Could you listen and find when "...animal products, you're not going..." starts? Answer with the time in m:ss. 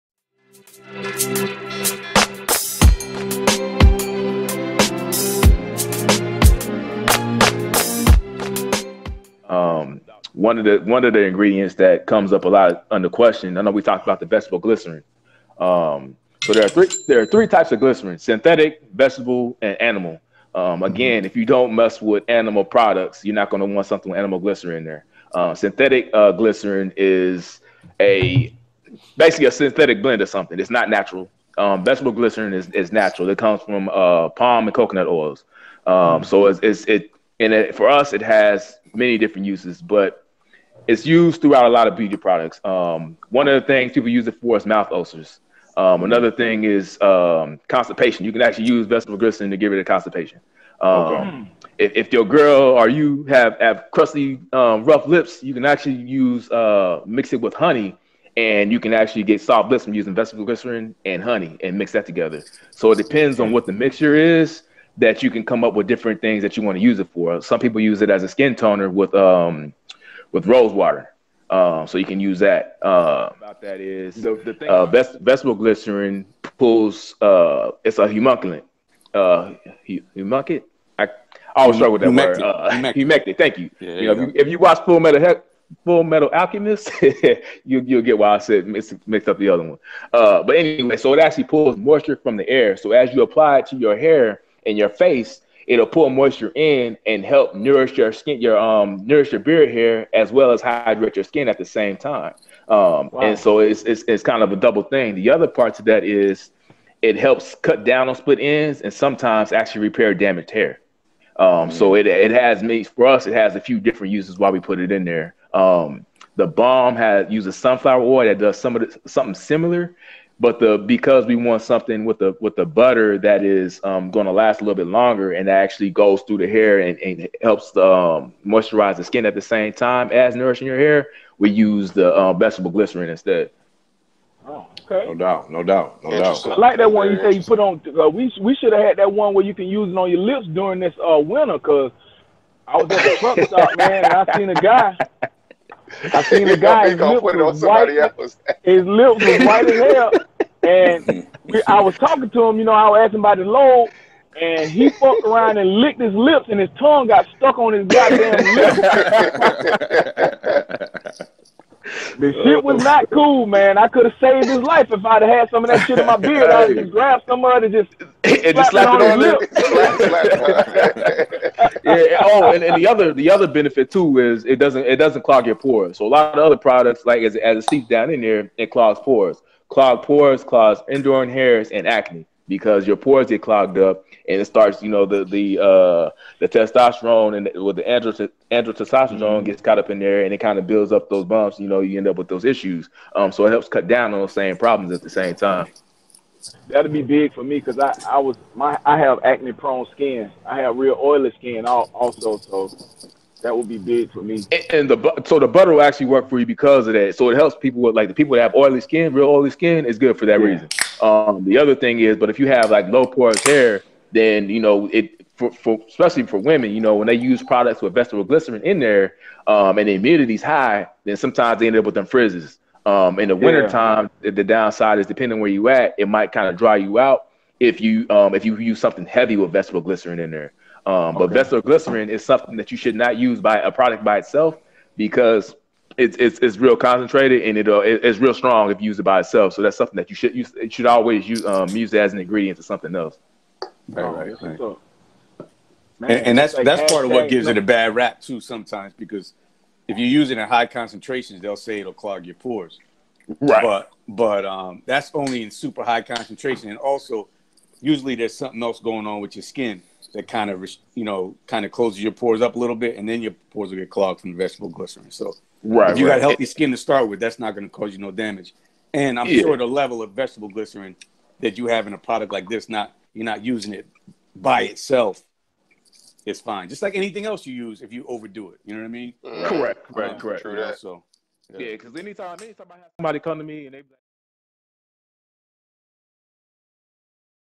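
0:22.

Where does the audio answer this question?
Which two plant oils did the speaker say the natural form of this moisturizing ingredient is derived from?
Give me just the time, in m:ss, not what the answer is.
0:34.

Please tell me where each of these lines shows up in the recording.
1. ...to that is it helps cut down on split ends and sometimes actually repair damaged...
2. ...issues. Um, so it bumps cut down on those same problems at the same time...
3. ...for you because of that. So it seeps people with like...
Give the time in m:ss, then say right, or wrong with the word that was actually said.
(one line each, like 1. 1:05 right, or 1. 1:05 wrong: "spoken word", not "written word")
1. 1:45 right
2. 3:12 wrong: "helps", not "bumps"
3. 3:26 wrong: "helps", not "seeps".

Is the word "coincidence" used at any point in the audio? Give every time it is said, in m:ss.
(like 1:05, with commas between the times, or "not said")
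not said.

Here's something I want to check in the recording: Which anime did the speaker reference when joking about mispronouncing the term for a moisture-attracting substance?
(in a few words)
Full Metal Alchemist.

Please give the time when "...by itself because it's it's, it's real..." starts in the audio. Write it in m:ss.
3:54.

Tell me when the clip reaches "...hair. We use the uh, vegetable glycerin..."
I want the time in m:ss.
2:10.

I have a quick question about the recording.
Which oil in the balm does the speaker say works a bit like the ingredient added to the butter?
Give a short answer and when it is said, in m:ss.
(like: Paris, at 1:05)
Sunflower oil, at 1:57.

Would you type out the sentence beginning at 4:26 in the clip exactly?
got healthy skin to start with, that's not going to cause you no damage.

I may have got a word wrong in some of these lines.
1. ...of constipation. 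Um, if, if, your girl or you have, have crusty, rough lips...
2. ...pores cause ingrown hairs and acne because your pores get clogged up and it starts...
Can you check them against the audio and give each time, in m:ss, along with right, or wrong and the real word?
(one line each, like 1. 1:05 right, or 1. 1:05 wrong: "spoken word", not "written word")
1. 0:49 right
2. 3:00 right.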